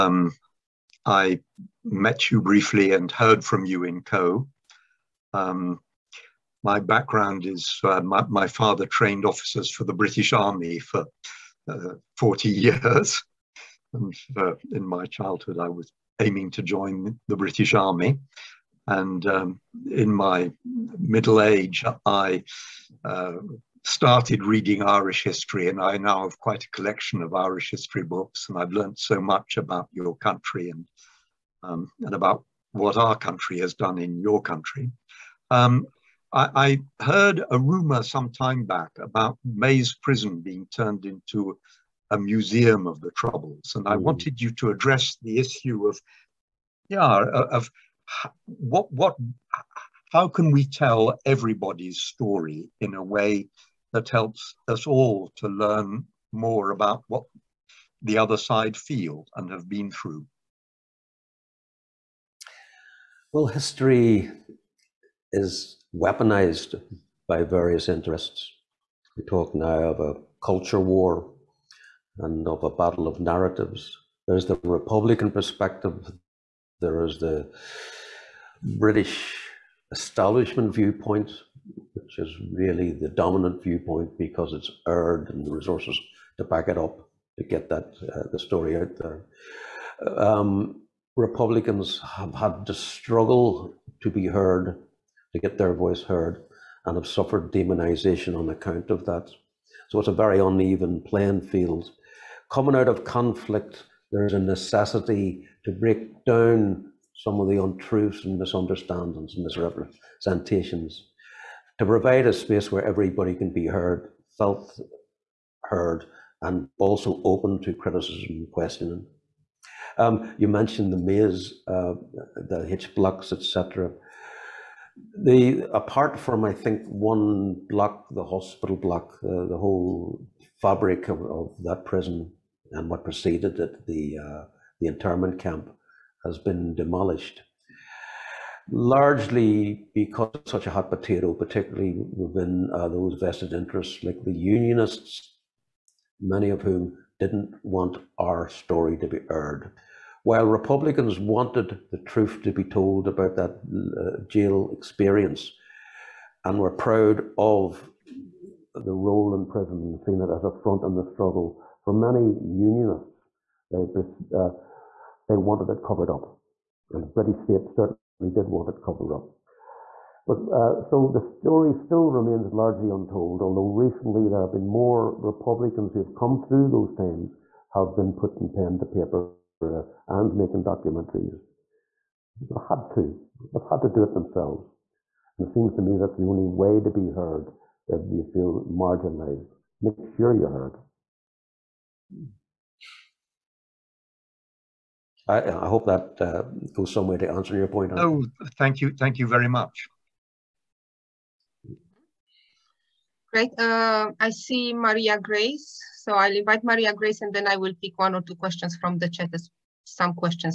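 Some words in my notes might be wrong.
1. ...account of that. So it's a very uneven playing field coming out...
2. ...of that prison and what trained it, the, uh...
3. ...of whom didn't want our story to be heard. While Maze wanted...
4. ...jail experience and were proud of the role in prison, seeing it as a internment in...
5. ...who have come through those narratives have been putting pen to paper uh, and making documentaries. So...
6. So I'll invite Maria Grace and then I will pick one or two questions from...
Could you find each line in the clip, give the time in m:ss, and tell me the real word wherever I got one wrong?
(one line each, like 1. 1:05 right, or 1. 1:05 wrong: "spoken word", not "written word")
1. 1:38 right
2. 2:11 wrong: "preceded", not "trained"
3. 2:26 wrong: "Republicans", not "Maze"
4. 2:34 wrong: "front", not "internment"
5. 2:55 wrong: "times", not "narratives"
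6. 3:25 right.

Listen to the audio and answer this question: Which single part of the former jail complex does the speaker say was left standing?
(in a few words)
The hospital block.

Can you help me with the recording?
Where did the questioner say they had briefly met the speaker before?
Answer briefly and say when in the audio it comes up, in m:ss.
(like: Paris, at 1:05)
Caux, at 0:04.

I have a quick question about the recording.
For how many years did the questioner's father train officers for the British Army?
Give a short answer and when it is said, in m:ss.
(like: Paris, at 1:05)
40, at 0:12.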